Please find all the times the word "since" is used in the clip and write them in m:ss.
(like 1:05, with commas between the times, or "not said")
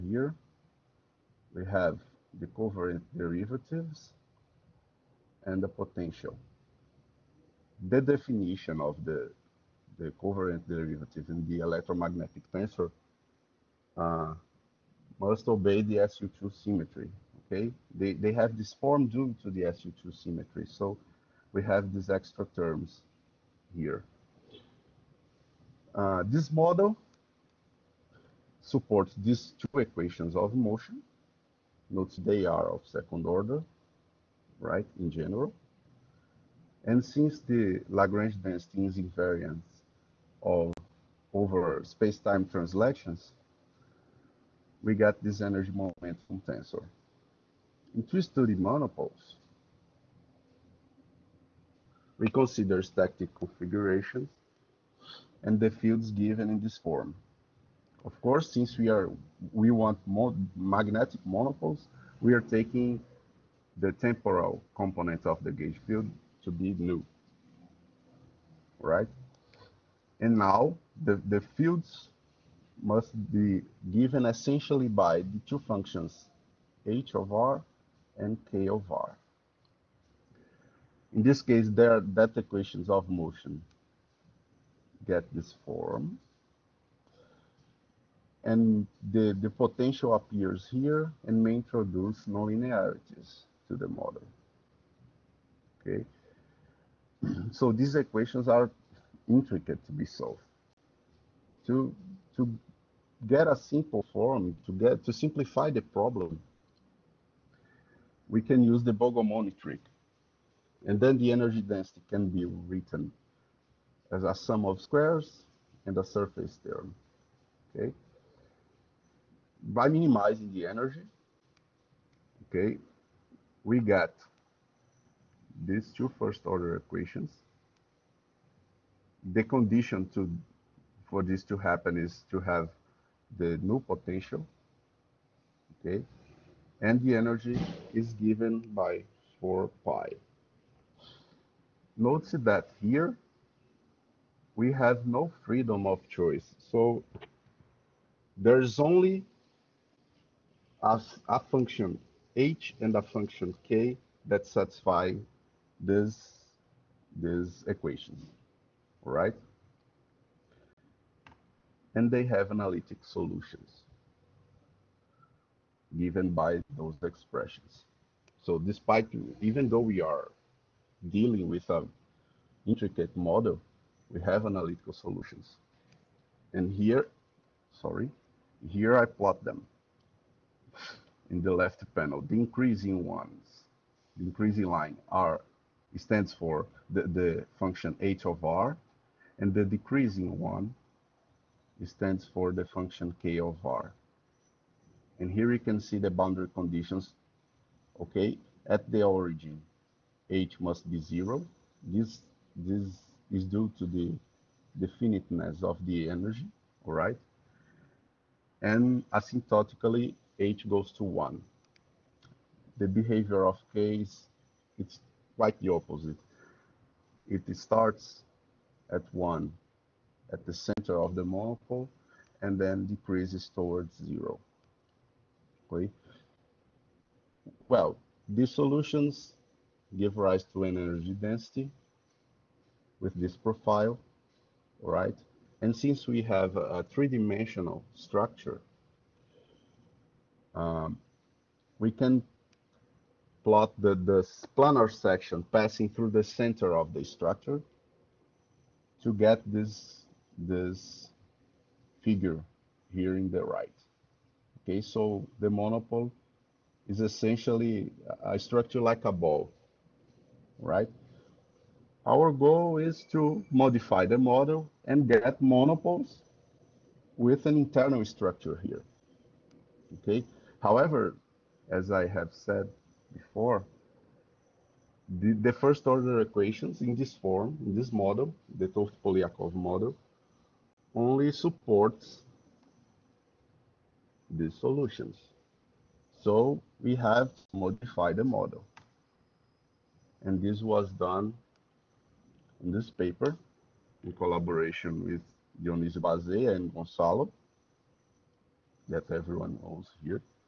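0:37, 0:58, 3:55.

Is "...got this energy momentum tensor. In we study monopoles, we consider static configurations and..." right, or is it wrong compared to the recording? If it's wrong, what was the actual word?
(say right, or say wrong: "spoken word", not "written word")
right.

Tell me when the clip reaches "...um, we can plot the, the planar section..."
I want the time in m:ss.
4:00.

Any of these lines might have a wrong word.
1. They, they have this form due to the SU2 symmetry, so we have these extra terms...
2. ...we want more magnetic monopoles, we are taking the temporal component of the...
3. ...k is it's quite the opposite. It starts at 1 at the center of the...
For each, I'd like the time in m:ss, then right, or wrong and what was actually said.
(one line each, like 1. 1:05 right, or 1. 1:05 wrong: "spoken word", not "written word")
1. 0:17 right
2. 0:59 right
3. 3:33 right.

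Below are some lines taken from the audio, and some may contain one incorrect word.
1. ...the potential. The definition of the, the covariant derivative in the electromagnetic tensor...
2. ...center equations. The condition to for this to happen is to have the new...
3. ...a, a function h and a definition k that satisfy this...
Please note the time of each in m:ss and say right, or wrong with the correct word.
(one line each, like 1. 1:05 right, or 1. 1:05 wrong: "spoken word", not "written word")
1. 0:05 right
2. 2:06 wrong: "order", not "center"
3. 2:30 wrong: "function", not "definition".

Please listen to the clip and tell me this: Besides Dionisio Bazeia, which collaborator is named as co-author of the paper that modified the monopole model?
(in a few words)
Gonzalo.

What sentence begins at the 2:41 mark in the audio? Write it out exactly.
And they have analytic solutions given by those expressions.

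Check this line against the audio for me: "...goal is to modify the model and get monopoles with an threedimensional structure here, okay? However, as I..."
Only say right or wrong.
wrong.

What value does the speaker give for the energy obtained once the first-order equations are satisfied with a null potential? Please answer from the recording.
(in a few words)
4 pi.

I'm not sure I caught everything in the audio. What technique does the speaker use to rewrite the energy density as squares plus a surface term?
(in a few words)
Bogomolny trick.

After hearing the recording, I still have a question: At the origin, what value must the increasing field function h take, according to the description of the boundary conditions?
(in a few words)
0.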